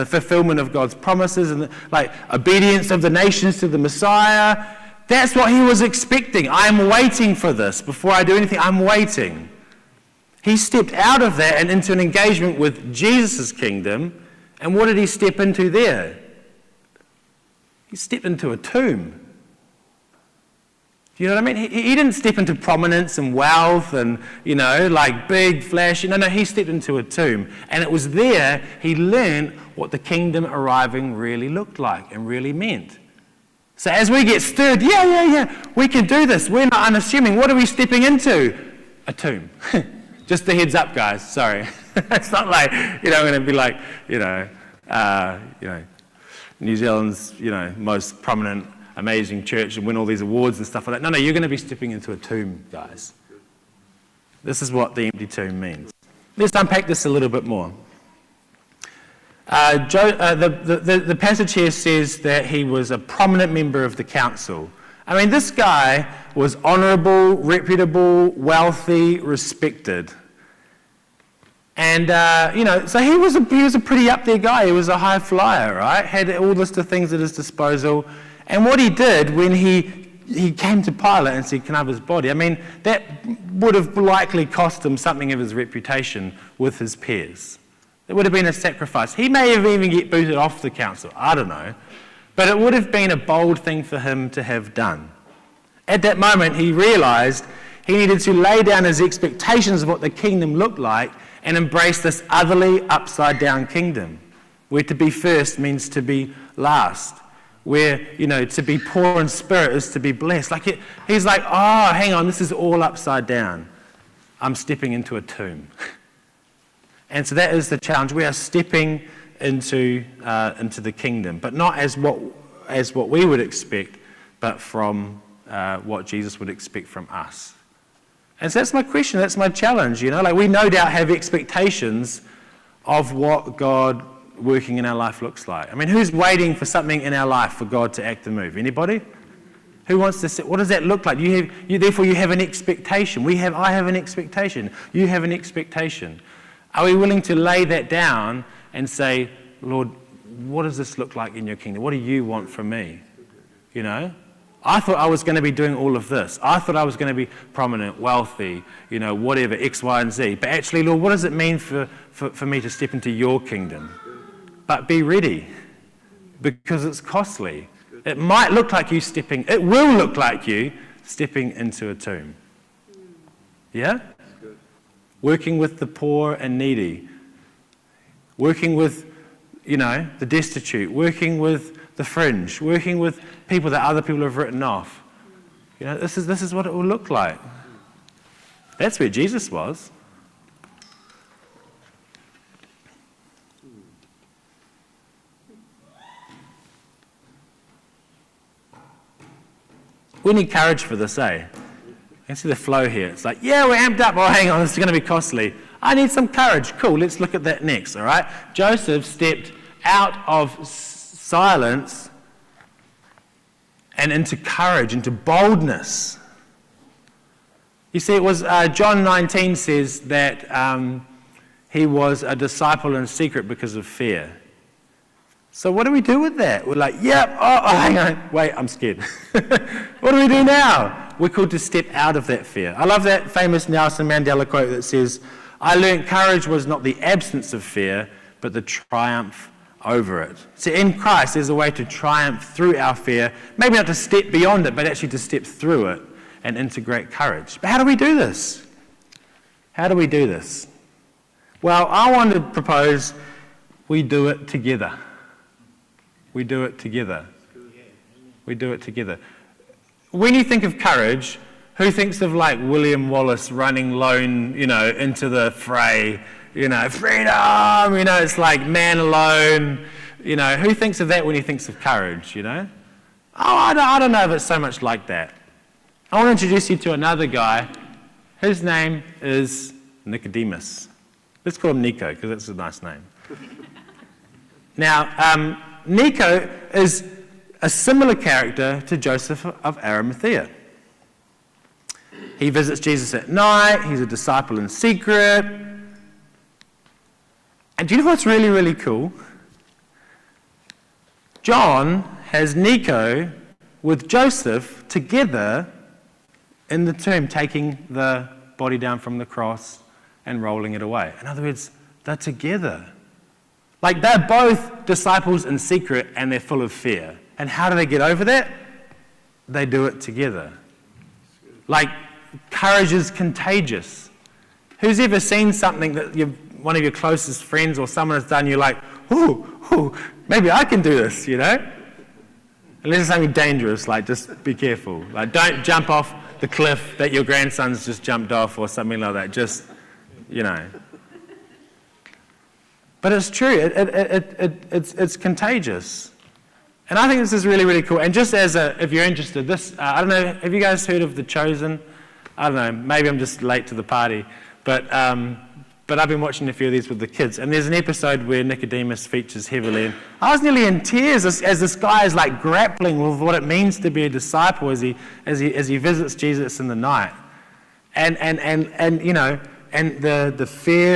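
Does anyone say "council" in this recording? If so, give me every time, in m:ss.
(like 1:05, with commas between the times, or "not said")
1:04, 1:30.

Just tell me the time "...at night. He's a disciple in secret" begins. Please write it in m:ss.
4:53.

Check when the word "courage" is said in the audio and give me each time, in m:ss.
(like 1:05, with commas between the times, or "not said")
3:20, 3:26, 3:34, 3:56, 4:07, 4:20, 4:31, 5:22.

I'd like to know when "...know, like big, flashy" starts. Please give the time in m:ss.
0:24.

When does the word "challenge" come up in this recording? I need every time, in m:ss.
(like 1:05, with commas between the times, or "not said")
1:57, 2:09.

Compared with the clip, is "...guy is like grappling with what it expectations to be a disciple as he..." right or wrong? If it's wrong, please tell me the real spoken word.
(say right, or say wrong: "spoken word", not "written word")
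wrong: "means", not "expectations".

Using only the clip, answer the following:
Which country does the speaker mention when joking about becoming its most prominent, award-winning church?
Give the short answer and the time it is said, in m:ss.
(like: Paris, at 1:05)
New Zealand, at 0:46.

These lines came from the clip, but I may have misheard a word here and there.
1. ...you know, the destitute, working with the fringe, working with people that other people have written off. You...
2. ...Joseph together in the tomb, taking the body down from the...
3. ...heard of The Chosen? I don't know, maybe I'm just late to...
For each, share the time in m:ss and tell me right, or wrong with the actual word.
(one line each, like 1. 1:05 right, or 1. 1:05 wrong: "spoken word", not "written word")
1. 2:59 right
2. 5:04 right
3. 5:50 right.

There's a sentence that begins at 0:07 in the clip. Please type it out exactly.
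Before I do anything, I'm waiting.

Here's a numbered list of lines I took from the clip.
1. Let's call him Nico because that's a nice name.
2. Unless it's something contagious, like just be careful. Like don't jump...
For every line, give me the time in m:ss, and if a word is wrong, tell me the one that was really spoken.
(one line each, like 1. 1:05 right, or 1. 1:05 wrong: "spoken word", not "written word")
1. 4:41 right
2. 5:32 wrong: "dangerous", not "contagious".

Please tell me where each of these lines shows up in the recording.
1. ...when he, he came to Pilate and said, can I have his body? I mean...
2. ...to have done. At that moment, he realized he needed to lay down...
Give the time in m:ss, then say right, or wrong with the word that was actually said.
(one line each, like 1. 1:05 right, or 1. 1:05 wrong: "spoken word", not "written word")
1. 1:19 right
2. 1:34 right.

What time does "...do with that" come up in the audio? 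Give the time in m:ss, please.
3:46.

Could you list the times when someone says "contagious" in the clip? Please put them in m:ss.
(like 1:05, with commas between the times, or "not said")
5:23, 5:45.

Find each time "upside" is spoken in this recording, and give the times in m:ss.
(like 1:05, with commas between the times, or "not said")
1:42, 1:52.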